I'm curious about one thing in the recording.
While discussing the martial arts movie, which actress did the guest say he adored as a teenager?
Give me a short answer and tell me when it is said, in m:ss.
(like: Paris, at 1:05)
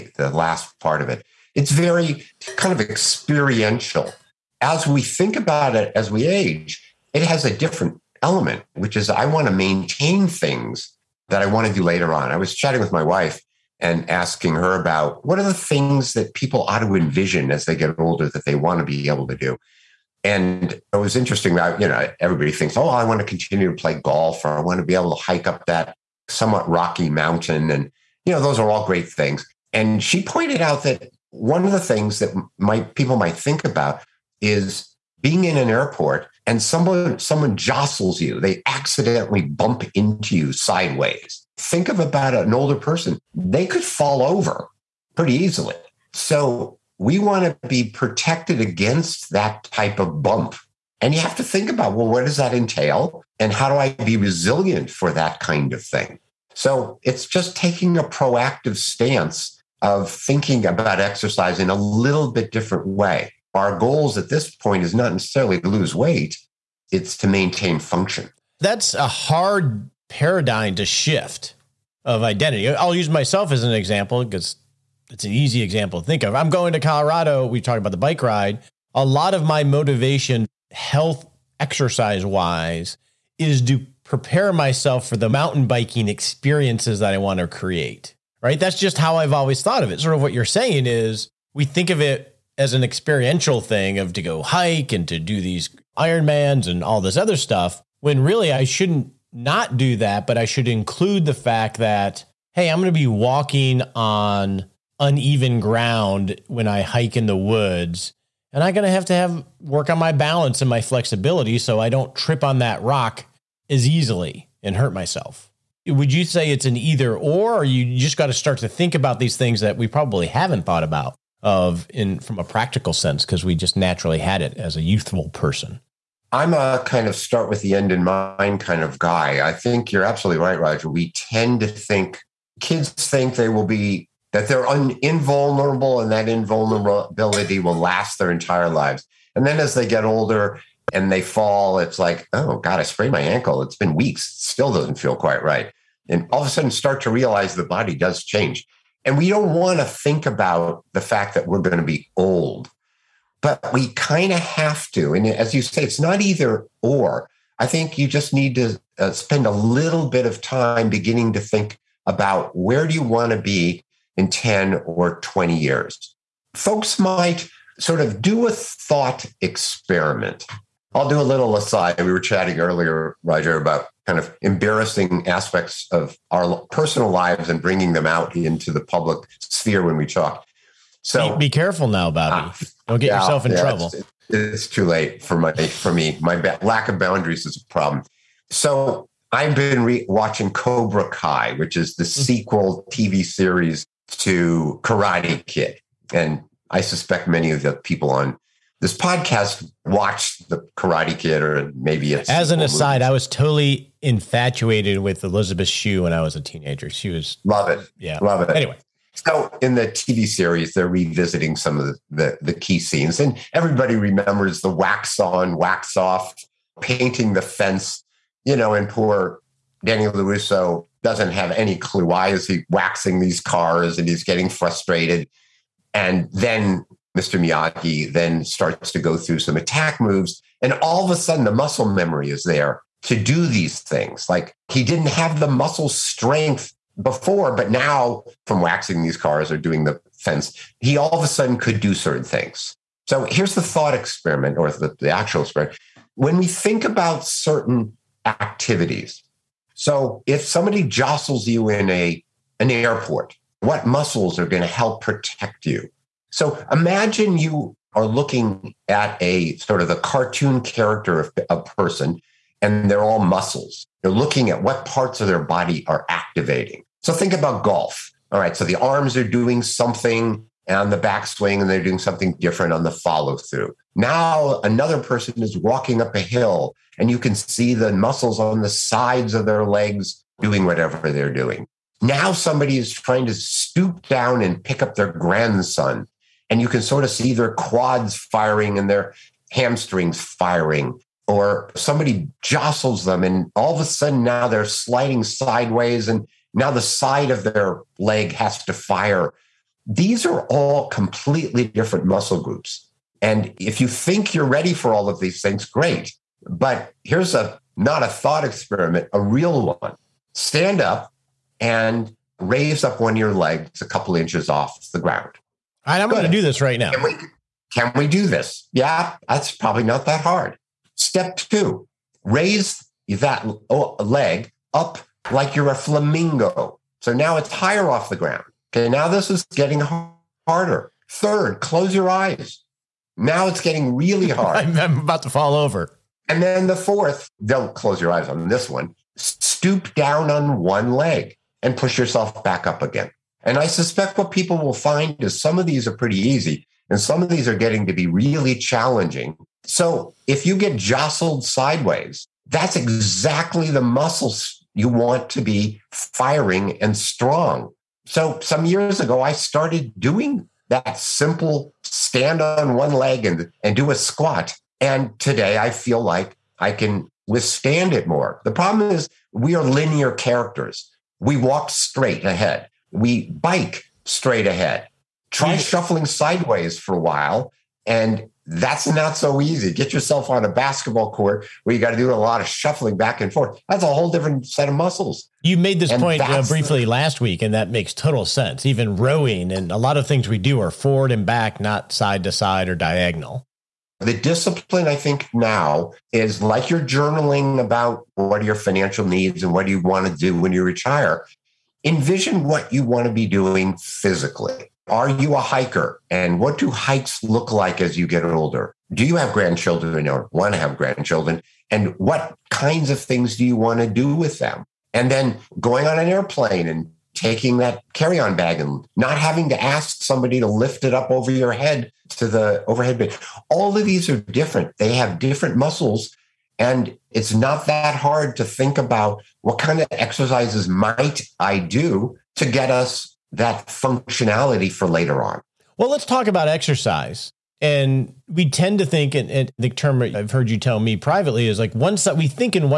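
Elizabeth Shue, at 3:25.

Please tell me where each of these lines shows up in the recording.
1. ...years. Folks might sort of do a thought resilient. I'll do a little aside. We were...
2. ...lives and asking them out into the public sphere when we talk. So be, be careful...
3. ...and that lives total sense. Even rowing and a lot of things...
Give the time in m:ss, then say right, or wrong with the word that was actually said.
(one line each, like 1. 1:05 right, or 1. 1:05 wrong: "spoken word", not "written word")
1. 2:45 wrong: "experiment", not "resilient"
2. 2:57 wrong: "bringing", not "asking"
3. 6:27 wrong: "makes", not "lives".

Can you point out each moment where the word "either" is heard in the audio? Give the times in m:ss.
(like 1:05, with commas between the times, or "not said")
1:56, 2:36.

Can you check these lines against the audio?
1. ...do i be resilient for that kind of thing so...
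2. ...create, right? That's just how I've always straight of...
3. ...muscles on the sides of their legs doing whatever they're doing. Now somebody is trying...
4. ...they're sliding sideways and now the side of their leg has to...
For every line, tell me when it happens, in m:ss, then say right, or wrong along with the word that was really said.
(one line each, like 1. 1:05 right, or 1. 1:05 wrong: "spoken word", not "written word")
1. 0:53 right
2. 1:27 wrong: "thought", not "straight"
3. 4:37 right
4. 4:54 right.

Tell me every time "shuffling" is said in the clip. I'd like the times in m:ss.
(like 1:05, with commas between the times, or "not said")
6:15, 6:22.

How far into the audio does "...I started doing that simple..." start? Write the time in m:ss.
5:59.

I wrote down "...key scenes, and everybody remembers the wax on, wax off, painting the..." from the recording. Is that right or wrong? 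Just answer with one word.
right.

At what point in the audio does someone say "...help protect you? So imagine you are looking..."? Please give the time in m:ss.
4:14.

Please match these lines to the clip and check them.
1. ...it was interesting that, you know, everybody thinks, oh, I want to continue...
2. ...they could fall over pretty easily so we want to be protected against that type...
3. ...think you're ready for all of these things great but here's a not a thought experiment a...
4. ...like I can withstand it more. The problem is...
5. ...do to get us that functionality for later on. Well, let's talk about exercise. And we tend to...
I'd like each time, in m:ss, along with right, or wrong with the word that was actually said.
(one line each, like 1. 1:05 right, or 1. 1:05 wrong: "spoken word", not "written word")
1. 0:20 right
2. 0:43 right
3. 5:03 right
4. 6:06 right
5. 7:11 right.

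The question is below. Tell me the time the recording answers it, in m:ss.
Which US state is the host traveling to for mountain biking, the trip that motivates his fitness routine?
1:16.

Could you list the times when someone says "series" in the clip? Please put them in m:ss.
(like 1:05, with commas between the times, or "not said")
3:13, 3:30.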